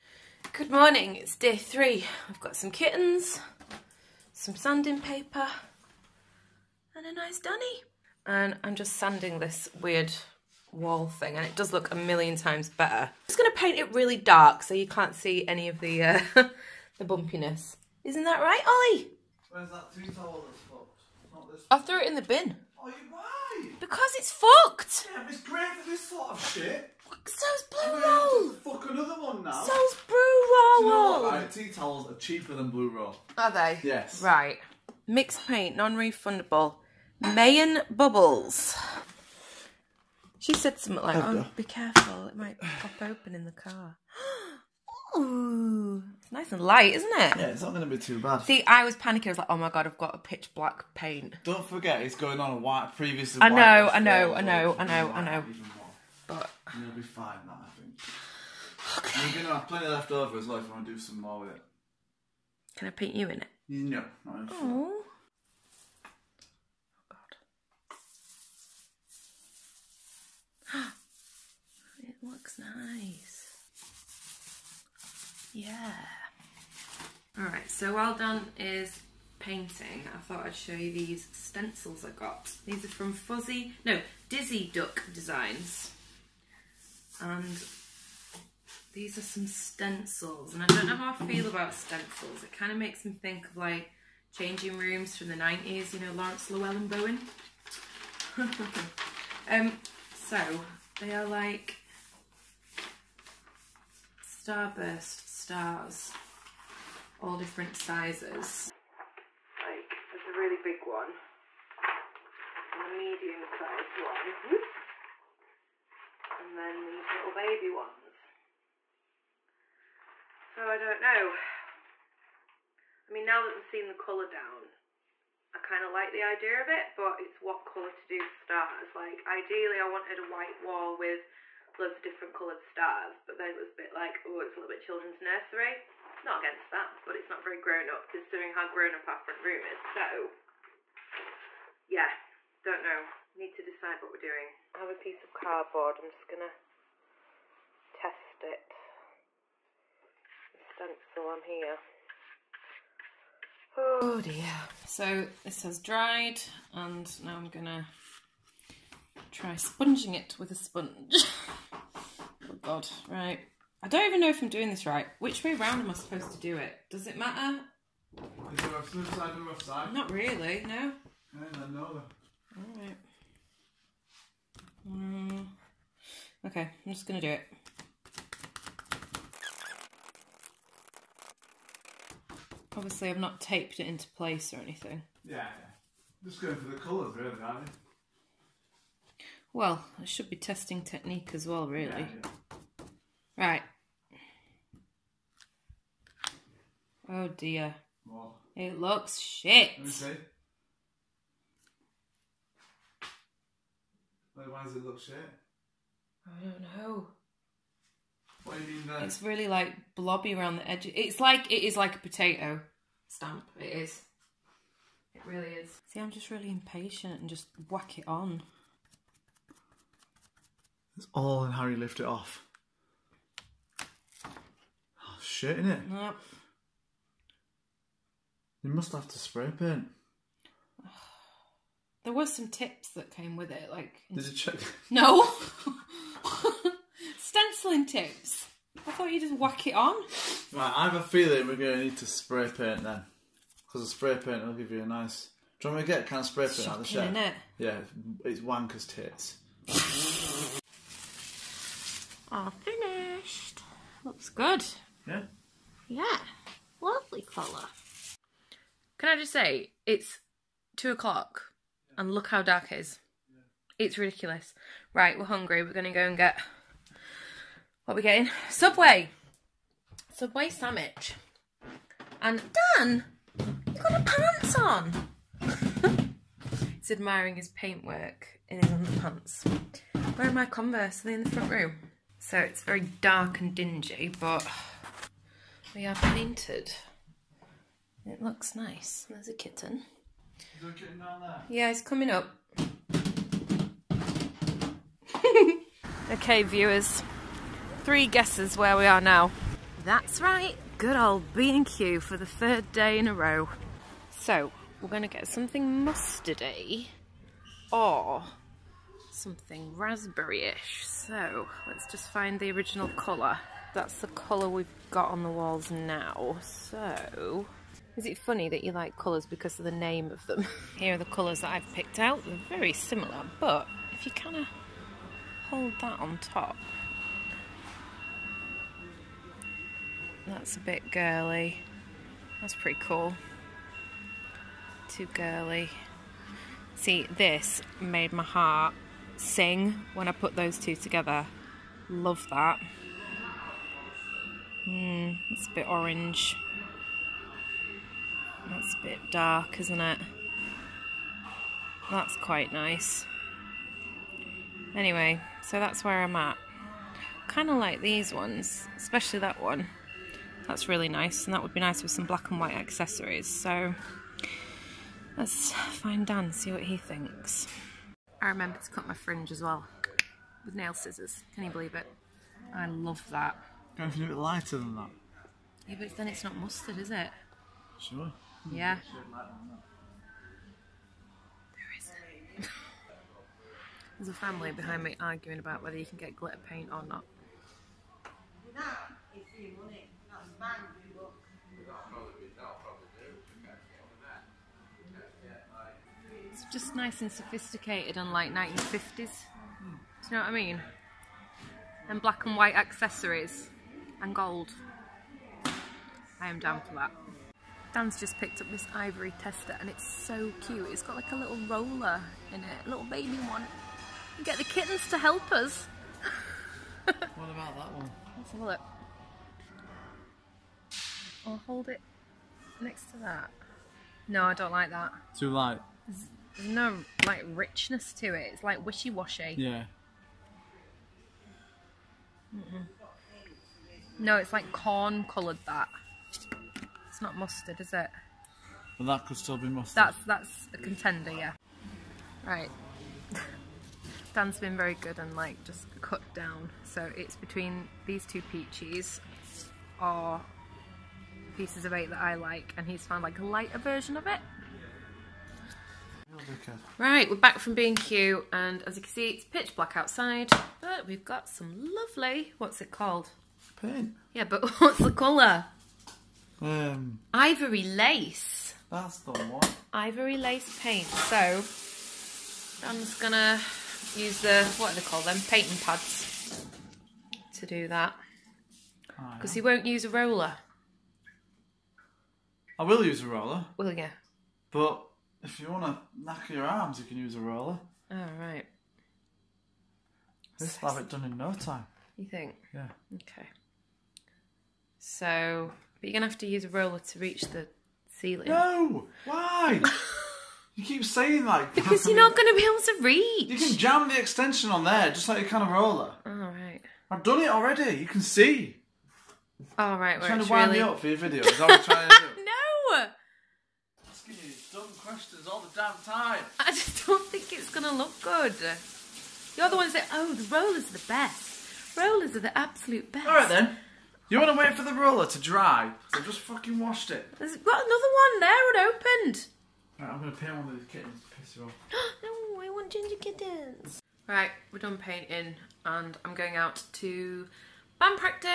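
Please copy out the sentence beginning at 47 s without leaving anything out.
Yeah, it's not going to be too bad.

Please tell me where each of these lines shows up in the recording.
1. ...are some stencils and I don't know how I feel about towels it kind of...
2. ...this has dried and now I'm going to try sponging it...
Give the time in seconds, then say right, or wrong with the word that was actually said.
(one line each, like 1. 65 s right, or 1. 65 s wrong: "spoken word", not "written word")
1. 89 s wrong: "stencils", not "towels"
2. 155 s right.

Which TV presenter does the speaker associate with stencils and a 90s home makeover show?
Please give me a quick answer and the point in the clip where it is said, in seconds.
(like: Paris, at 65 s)
Laurence Llewelyn-Bowen, at 96 s.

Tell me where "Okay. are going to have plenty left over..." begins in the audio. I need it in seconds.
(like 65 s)
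58 s.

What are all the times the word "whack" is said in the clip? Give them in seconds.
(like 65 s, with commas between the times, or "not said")
217 s, 239 s.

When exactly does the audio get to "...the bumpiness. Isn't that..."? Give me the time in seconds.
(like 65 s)
16 s.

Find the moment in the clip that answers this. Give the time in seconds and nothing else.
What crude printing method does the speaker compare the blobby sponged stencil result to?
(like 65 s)
211 s.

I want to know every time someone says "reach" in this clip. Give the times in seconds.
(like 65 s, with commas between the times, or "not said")
496 s, 502 s.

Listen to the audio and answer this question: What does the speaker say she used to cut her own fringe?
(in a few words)
nail scissors.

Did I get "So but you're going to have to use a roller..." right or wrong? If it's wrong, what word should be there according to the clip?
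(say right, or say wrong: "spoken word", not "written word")
right.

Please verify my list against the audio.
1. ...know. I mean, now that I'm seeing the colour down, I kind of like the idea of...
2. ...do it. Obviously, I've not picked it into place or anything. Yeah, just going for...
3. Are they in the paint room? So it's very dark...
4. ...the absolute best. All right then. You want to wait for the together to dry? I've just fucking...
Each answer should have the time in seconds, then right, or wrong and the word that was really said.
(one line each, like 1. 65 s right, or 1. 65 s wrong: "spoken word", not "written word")
1. 121 s right
2. 177 s wrong: "taped", not "picked"
3. 281 s wrong: "front", not "paint"
4. 522 s wrong: "roller", not "together".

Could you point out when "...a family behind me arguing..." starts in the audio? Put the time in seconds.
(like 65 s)
384 s.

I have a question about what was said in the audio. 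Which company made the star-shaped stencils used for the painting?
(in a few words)
Dizzy Duck Designs.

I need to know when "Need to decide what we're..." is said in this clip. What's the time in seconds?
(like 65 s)
143 s.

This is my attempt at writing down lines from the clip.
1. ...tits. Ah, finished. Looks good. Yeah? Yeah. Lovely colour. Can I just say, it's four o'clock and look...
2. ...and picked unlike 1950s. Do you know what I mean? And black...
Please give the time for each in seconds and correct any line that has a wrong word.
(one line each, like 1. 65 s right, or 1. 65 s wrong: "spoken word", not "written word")
1. 248 s wrong: "two", not "four"
2. 397 s wrong: "sophisticated", not "picked".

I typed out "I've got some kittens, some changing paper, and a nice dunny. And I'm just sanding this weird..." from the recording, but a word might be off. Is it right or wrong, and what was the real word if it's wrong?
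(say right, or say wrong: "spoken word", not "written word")
wrong: "sanding", not "changing".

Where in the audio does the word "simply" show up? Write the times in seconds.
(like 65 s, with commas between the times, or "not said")
not said.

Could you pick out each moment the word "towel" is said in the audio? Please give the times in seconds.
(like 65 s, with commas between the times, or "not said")
20 s, 31 s.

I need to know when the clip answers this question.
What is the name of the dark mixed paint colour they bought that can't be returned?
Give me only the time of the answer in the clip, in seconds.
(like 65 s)
37 s.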